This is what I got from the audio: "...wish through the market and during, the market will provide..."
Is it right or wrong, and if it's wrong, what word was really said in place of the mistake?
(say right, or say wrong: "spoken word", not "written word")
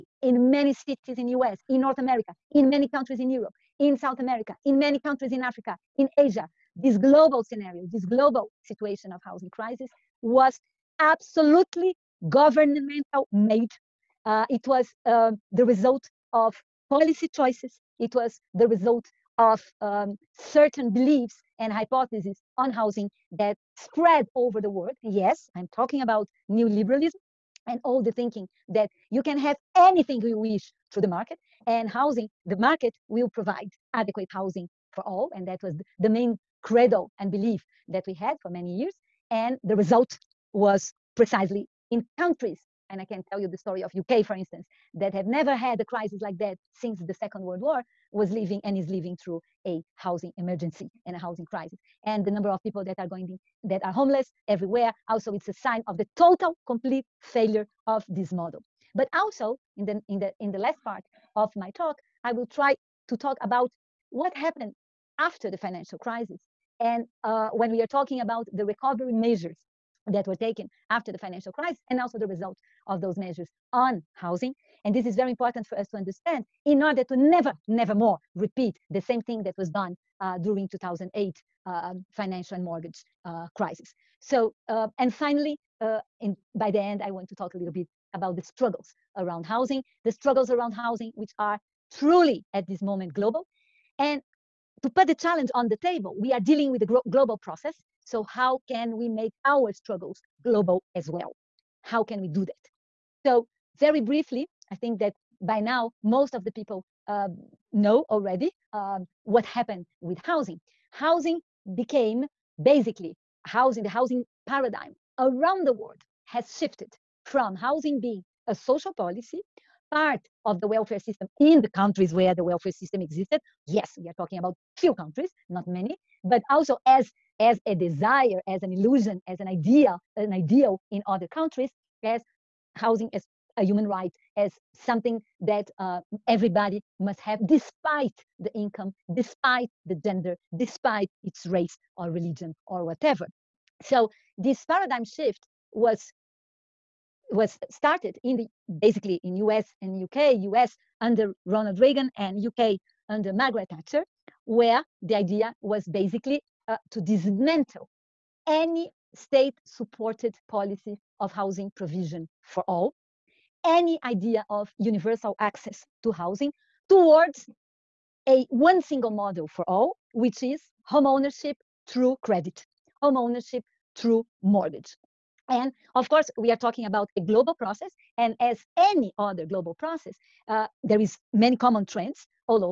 wrong: "housing", not "during".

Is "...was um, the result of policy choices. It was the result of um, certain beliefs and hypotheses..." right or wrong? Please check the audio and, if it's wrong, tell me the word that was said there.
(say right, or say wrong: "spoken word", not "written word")
right.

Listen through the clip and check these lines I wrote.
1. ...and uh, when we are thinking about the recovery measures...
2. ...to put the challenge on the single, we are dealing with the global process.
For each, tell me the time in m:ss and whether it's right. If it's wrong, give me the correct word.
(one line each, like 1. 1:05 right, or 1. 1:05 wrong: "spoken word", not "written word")
1. 1:06 wrong: "talking", not "thinking"
2. 1:34 wrong: "table", not "single".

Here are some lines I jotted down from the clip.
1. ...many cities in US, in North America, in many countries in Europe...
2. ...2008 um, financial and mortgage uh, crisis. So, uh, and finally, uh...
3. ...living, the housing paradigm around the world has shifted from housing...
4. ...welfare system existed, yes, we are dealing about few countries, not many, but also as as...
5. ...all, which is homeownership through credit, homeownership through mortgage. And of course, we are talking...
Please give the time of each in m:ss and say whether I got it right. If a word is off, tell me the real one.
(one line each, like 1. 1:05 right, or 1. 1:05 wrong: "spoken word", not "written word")
1. 0:00 right
2. 1:20 right
3. 1:53 wrong: "housing", not "living"
4. 2:02 wrong: "talking", not "dealing"
5. 2:49 right.